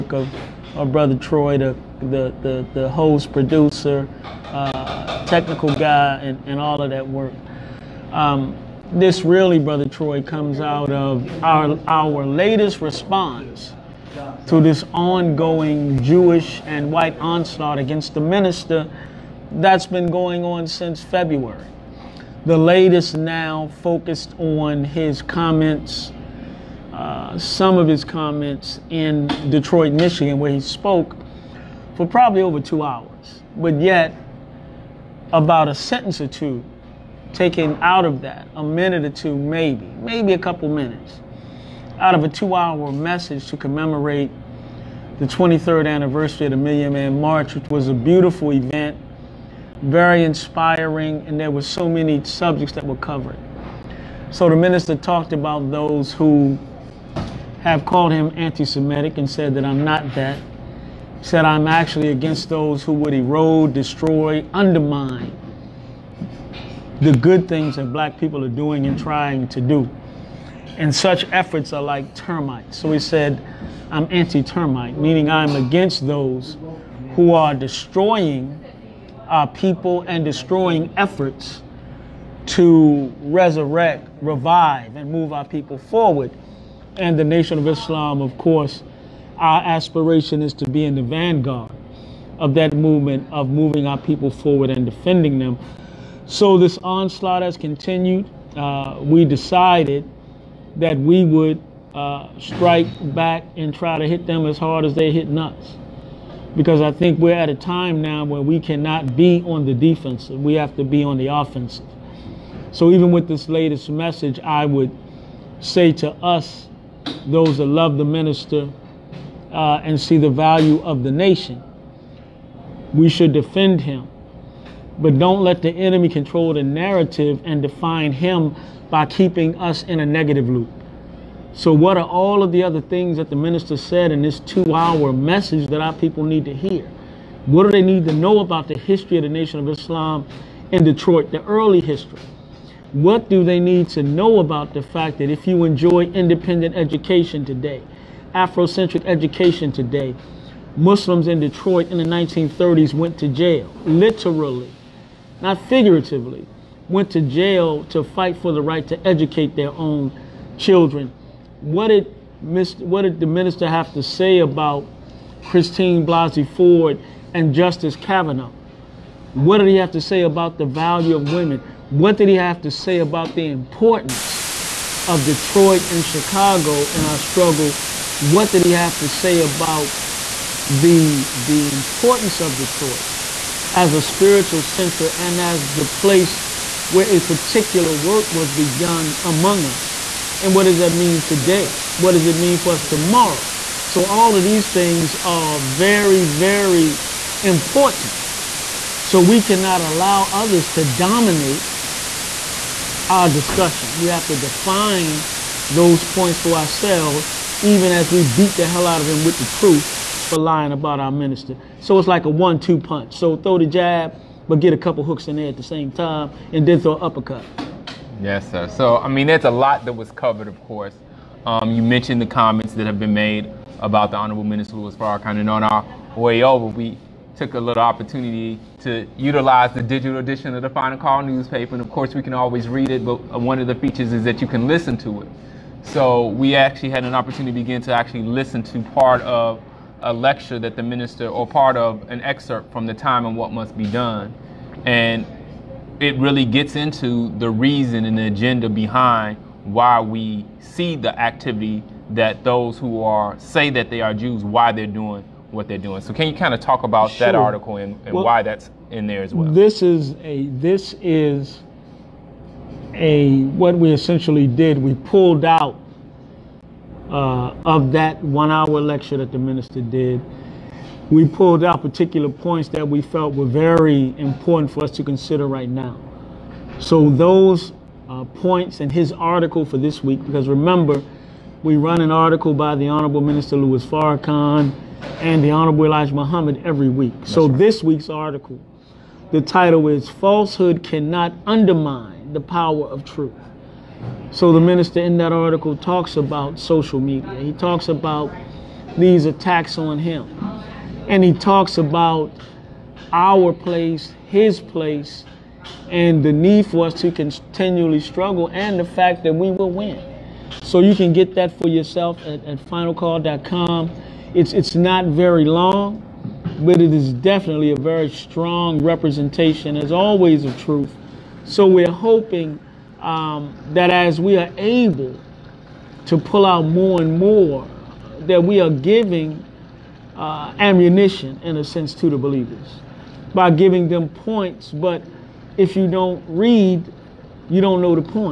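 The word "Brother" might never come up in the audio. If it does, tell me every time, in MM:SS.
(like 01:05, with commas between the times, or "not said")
00:00, 00:09.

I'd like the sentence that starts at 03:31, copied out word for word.
So it's like a one-two punch.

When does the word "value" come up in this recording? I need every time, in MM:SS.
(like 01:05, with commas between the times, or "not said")
02:00, 02:50.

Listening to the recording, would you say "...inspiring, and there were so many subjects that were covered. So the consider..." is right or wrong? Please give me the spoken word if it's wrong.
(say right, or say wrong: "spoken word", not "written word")
wrong: "minister", not "consider".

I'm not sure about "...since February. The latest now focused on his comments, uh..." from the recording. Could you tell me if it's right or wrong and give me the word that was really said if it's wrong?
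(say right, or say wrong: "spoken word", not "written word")
right.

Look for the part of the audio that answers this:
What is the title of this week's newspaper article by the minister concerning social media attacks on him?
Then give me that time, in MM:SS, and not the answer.
04:50.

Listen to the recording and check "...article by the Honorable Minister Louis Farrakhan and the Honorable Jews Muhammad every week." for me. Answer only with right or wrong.
wrong.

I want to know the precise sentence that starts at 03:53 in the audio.
But one of the features is that you can listen to it.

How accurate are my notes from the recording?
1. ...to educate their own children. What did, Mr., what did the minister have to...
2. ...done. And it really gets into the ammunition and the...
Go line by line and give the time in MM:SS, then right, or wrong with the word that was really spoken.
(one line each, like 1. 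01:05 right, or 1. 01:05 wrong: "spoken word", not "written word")
1. 02:38 right
2. 04:03 wrong: "reason", not "ammunition".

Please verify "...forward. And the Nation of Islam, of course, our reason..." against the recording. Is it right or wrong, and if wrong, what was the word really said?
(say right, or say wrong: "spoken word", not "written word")
wrong: "aspiration", not "reason".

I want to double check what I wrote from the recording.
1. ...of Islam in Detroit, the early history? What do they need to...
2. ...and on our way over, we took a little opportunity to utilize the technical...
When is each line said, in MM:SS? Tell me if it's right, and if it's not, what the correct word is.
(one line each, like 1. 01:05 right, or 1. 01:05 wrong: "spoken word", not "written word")
1. 02:19 right
2. 03:45 wrong: "digital", not "technical".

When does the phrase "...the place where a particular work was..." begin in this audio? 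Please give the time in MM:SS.
03:05.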